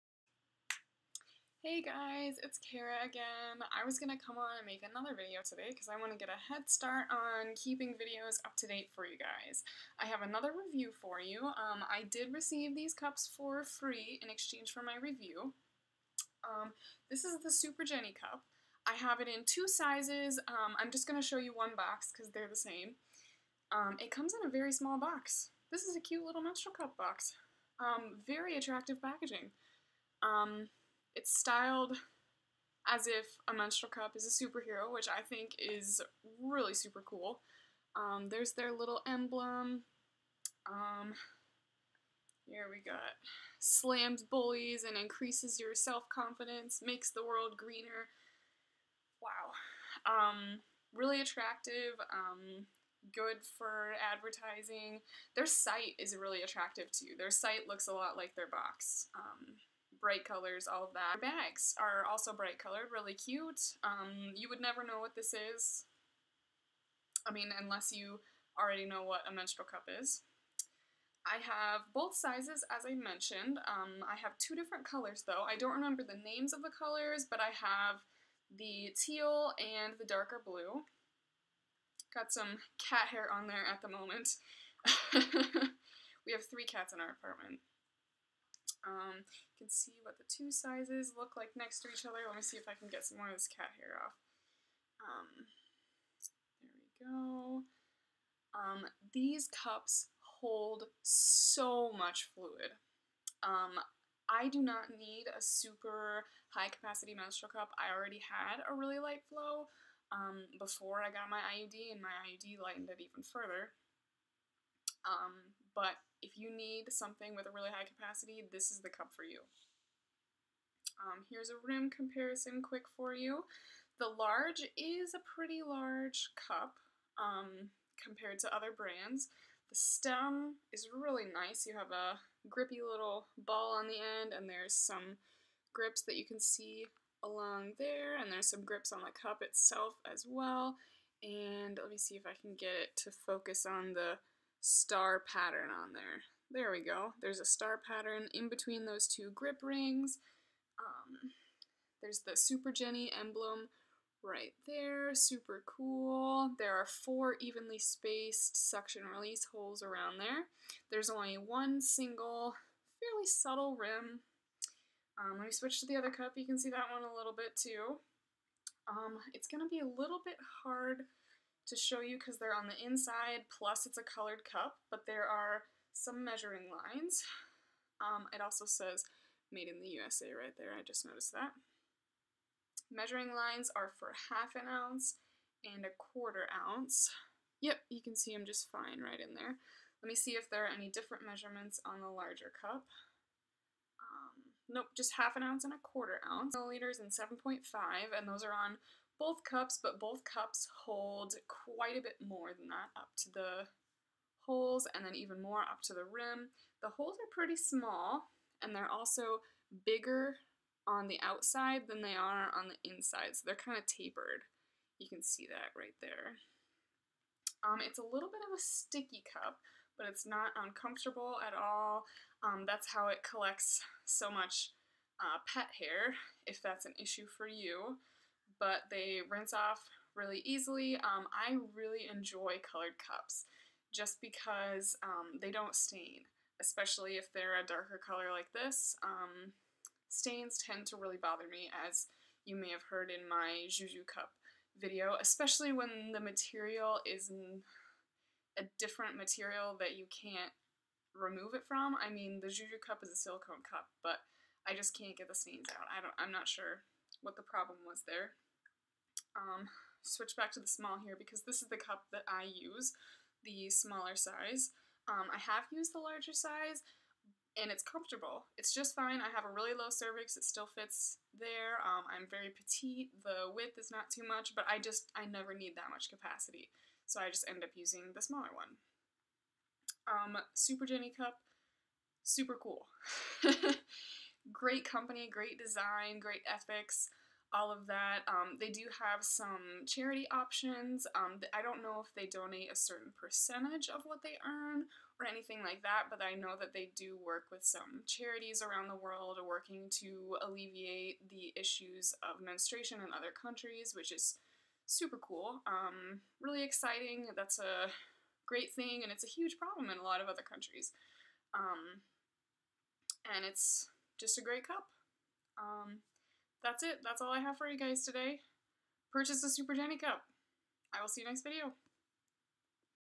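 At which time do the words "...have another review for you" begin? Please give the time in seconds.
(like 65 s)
10 s.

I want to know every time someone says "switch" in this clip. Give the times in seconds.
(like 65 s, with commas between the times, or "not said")
165 s, 260 s.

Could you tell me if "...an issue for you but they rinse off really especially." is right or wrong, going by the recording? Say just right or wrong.
wrong.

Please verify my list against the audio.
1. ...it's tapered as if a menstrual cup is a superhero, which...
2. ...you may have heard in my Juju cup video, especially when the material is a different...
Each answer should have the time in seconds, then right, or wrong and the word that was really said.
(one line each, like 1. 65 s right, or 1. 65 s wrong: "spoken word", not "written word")
1. 31 s wrong: "styled", not "tapered"
2. 242 s right.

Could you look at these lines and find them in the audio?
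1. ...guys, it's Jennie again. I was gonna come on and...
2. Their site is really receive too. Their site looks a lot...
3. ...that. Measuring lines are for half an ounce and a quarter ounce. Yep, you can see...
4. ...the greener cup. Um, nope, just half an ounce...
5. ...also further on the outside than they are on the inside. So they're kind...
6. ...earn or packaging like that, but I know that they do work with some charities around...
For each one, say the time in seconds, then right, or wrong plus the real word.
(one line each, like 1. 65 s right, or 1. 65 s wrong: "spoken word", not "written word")
1. 1 s wrong: "Kara", not "Jennie"
2. 55 s wrong: "attractive", not "receive"
3. 181 s right
4. 192 s wrong: "larger", not "greener"
5. 208 s wrong: "bigger", not "further"
6. 294 s wrong: "anything", not "packaging".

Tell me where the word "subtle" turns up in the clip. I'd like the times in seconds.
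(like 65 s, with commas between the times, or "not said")
163 s.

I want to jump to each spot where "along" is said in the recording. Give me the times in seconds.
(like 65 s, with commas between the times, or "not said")
137 s.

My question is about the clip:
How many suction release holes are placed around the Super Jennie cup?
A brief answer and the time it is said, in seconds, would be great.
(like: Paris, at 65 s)
4, at 156 s.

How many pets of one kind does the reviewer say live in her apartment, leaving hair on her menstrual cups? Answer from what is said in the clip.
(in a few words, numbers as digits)
3.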